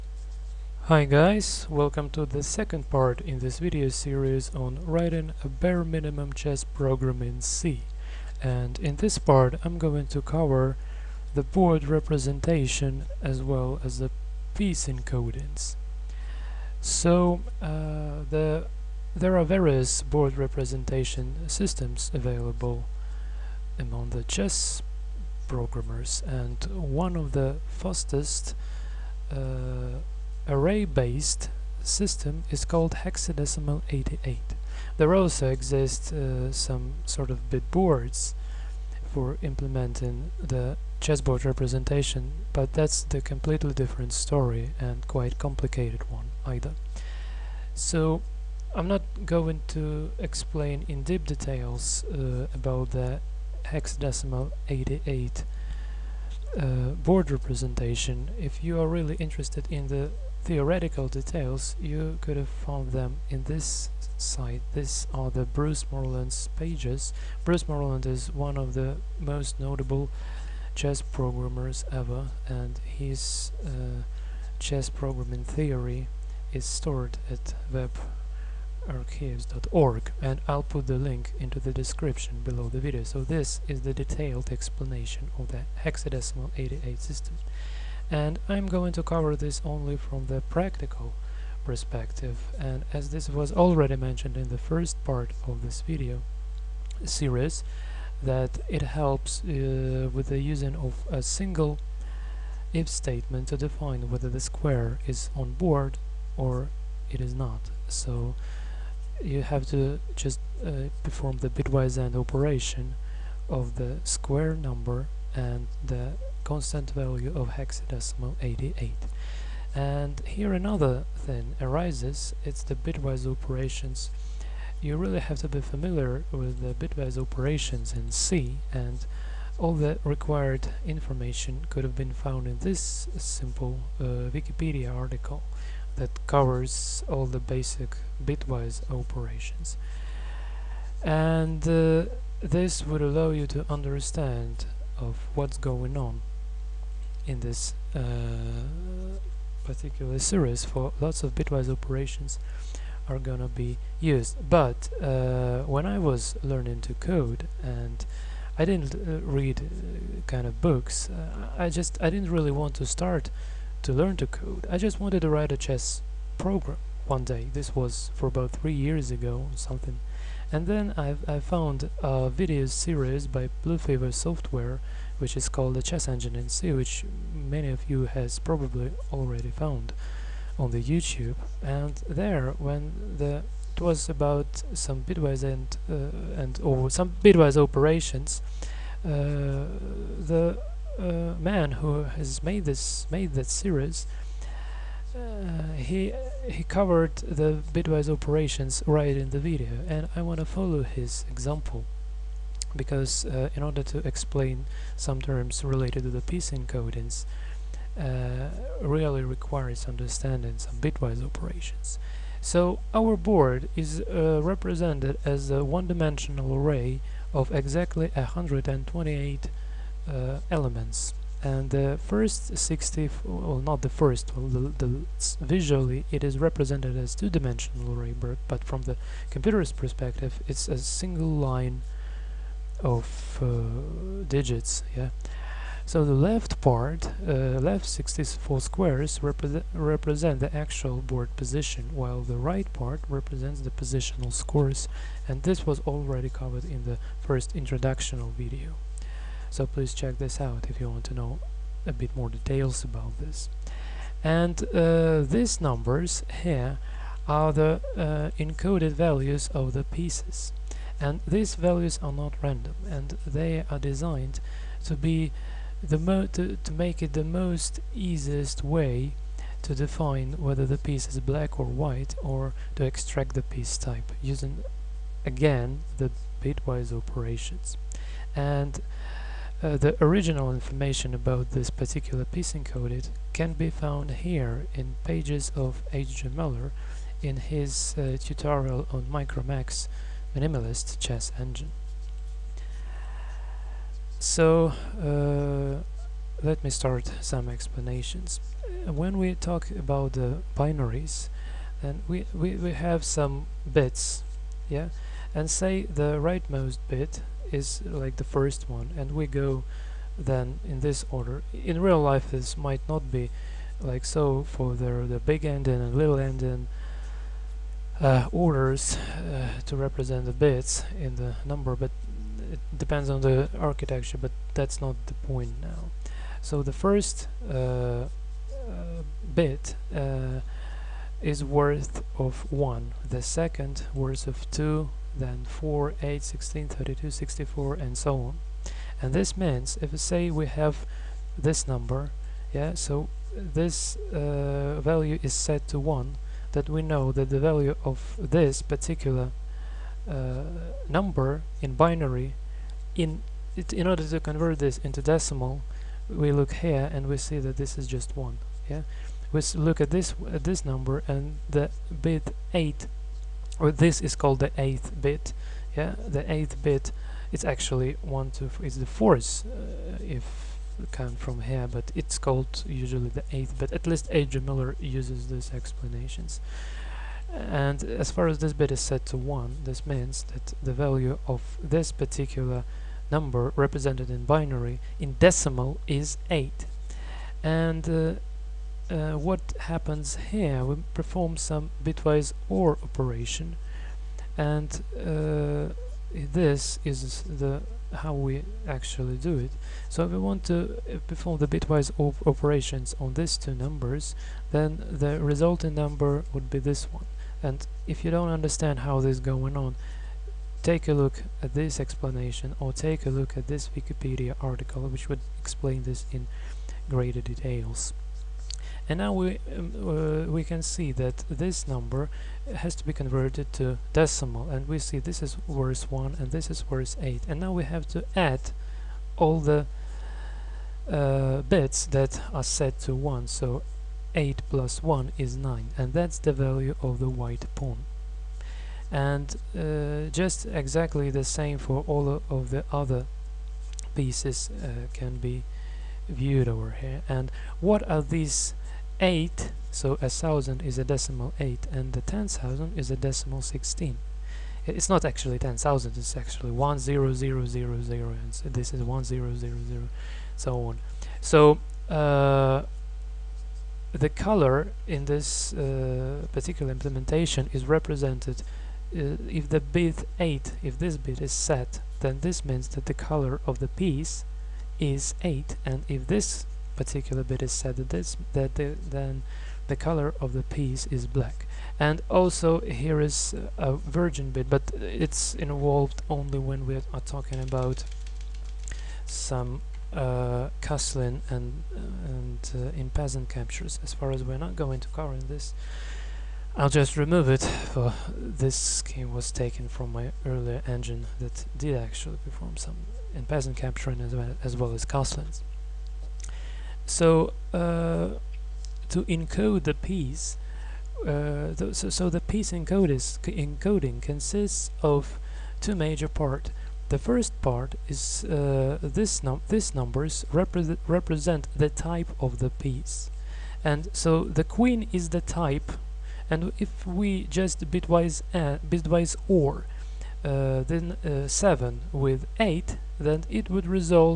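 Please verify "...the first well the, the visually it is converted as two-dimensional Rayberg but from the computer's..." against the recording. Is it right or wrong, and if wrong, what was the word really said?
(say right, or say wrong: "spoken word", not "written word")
wrong: "represented", not "converted".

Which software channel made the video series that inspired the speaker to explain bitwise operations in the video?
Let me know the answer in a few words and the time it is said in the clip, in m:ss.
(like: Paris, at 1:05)
Bluefever Software, at 2:53.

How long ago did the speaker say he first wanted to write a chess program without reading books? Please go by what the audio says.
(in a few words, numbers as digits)
about three years.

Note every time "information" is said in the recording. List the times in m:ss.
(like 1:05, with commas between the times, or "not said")
2:10, 4:40.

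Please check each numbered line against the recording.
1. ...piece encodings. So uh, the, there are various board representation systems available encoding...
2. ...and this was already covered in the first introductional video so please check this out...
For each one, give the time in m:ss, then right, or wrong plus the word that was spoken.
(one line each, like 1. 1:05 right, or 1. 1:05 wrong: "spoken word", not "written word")
1. 0:14 wrong: "among", not "encoding"
2. 4:05 right.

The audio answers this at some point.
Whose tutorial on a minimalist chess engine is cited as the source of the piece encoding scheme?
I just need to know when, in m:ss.
4:45.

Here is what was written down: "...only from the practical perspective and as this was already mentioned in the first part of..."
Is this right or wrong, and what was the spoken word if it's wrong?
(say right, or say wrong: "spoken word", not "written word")
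right.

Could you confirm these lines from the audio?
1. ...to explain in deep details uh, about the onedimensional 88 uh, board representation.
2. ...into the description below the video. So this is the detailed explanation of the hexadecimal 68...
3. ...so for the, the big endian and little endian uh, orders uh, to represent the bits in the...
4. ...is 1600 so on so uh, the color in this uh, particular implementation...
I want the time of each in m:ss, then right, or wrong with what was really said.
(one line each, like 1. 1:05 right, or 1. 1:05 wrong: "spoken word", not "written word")
1. 0:49 wrong: "hexadecimal", not "onedimensional"
2. 1:21 wrong: "88", not "68"
3. 5:14 right
4. 7:38 wrong: "1000", not "1600".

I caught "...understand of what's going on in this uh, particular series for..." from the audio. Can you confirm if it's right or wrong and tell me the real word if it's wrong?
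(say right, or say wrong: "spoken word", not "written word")
right.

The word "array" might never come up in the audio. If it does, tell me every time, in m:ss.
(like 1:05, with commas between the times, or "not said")
0:30, 3:36.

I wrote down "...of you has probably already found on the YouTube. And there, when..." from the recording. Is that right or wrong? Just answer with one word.
right.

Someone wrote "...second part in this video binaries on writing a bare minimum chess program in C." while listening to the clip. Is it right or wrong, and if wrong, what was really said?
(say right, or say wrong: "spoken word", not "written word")
wrong: "series", not "binaries".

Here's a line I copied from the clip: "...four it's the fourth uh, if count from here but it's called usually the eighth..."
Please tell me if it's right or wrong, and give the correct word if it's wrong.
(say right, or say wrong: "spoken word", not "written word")
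wrong: "two", not "four".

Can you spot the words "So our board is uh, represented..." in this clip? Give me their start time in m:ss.
3:32.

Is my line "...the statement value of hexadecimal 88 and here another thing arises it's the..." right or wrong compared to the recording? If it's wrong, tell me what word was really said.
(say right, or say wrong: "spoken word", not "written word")
wrong: "constant", not "statement".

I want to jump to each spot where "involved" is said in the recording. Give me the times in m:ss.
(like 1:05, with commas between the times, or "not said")
8:05.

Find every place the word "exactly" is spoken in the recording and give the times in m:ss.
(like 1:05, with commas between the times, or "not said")
3:37, 7:20.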